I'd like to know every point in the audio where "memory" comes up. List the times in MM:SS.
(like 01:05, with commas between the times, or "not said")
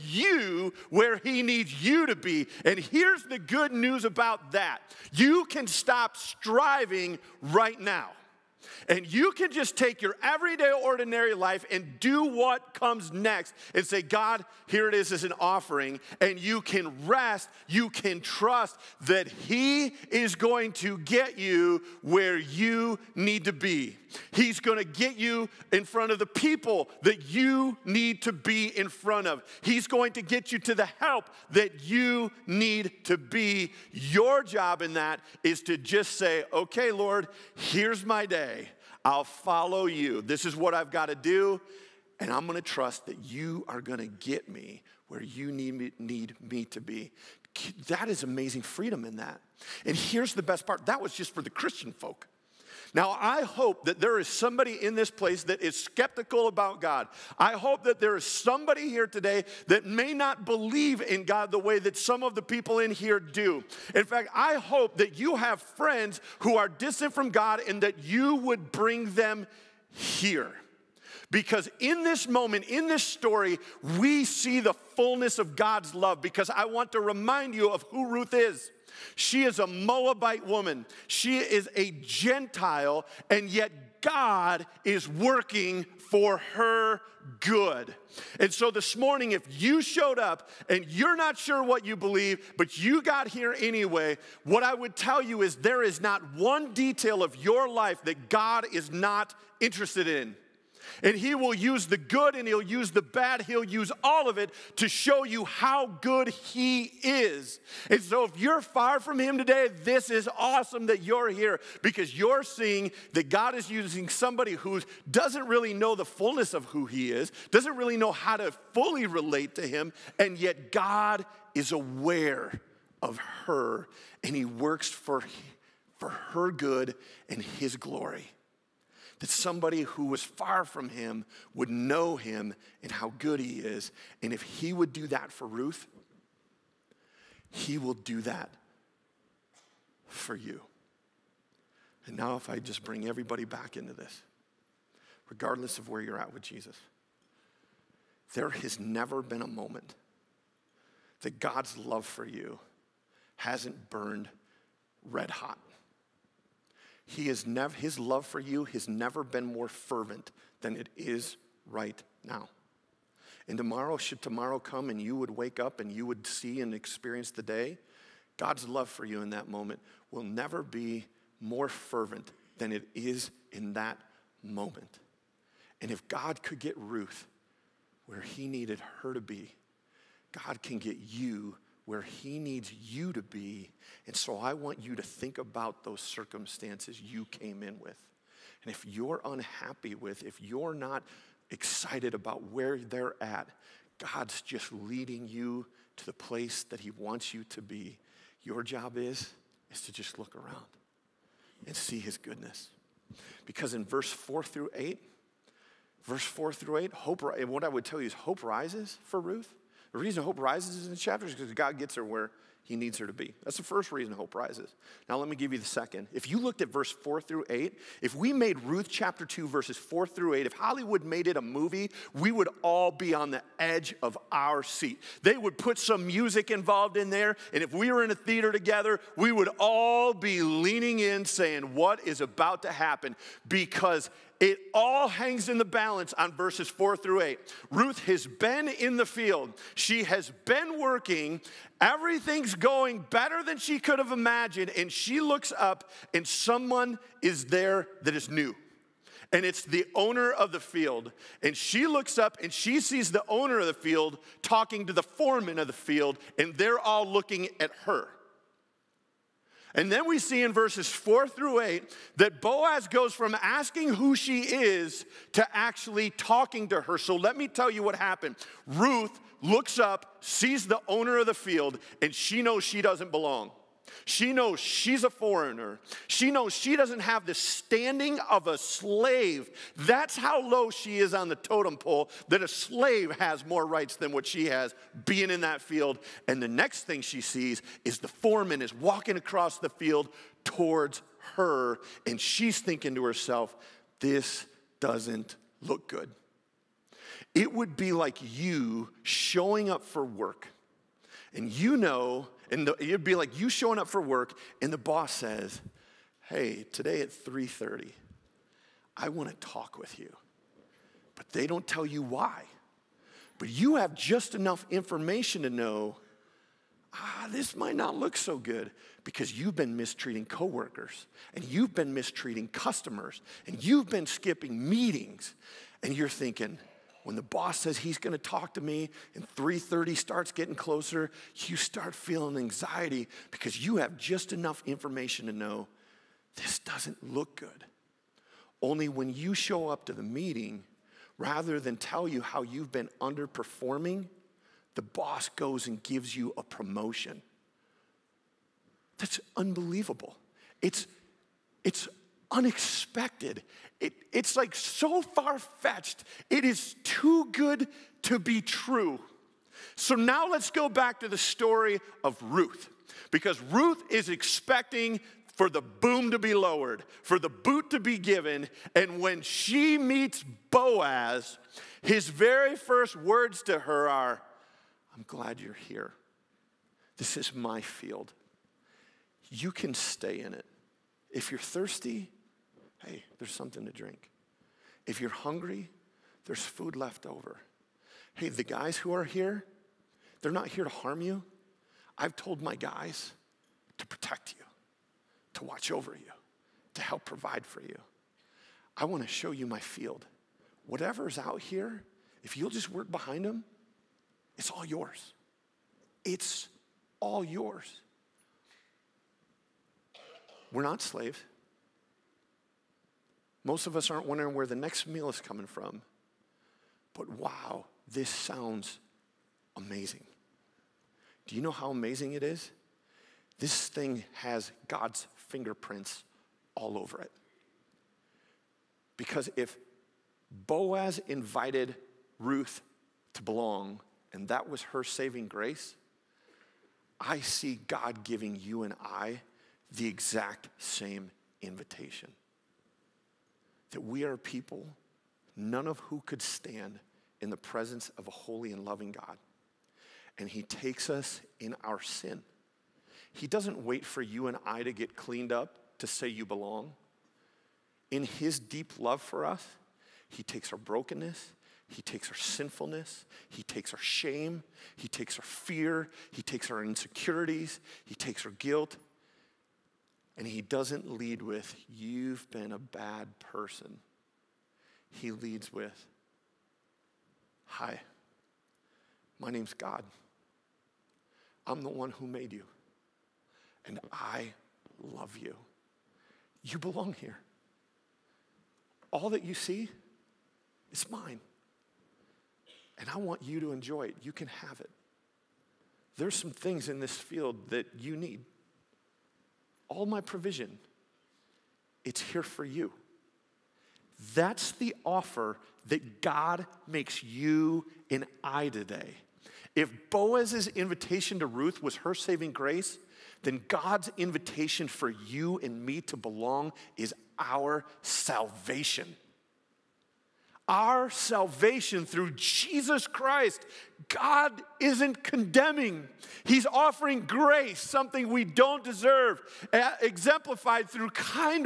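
not said.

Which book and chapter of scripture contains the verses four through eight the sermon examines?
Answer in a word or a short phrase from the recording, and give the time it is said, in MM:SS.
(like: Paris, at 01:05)
Ruth chapter 2, at 03:38.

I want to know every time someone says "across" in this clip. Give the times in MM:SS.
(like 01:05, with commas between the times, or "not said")
04:49.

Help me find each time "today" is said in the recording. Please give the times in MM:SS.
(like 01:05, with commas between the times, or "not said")
00:59, 01:49, 05:06, 08:28.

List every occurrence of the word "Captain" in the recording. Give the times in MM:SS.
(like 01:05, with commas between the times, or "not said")
not said.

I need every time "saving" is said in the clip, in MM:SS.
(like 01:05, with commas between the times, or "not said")
07:14, 08:31.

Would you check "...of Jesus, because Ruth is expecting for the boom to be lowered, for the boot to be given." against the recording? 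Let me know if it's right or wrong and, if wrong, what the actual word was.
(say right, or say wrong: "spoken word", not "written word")
wrong: "Ruth", not "Jesus".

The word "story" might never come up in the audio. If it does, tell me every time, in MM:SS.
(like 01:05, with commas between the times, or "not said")
01:13, 06:01.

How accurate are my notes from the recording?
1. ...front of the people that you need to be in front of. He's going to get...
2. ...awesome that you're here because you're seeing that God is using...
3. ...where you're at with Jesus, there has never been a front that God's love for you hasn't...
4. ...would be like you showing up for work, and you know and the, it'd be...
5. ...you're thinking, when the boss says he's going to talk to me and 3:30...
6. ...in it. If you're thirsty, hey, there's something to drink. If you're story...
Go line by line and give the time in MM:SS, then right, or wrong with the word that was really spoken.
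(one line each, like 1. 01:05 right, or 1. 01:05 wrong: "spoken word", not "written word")
1. 00:25 right
2. 01:50 right
3. 02:25 wrong: "moment", not "front"
4. 04:57 right
5. 05:25 right
6. 06:20 wrong: "hungry", not "story".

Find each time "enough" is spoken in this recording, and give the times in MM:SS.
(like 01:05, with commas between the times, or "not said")
05:14, 05:34.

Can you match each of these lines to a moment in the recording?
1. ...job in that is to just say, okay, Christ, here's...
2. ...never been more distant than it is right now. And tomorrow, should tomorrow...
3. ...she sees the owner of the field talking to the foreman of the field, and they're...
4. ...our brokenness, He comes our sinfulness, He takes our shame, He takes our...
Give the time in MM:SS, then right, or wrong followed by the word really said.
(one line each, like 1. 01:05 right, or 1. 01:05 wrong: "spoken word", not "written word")
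1. 00:34 wrong: "Lord", not "Christ"
2. 02:38 wrong: "fervent", not "distant"
3. 04:12 right
4. 07:40 wrong: "takes", not "comes".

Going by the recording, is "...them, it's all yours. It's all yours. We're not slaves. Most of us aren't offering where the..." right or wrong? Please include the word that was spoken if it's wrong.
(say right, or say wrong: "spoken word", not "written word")
wrong: "wondering", not "offering".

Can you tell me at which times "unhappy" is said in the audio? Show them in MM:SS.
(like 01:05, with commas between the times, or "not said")
03:09.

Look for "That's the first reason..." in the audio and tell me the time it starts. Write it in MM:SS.
03:33.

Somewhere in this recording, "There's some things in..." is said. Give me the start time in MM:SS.
08:15.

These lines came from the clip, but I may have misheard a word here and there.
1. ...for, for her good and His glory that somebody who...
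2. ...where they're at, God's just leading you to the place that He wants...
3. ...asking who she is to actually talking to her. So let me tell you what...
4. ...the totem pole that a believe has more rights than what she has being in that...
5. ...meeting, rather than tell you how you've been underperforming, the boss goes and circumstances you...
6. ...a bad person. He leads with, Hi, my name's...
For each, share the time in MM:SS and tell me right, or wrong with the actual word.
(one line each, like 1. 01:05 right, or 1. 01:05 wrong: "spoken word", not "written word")
1. 02:04 right
2. 03:12 right
3. 04:23 right
4. 04:41 wrong: "slave", not "believe"
5. 05:40 wrong: "gives", not "circumstances"
6. 07:52 right.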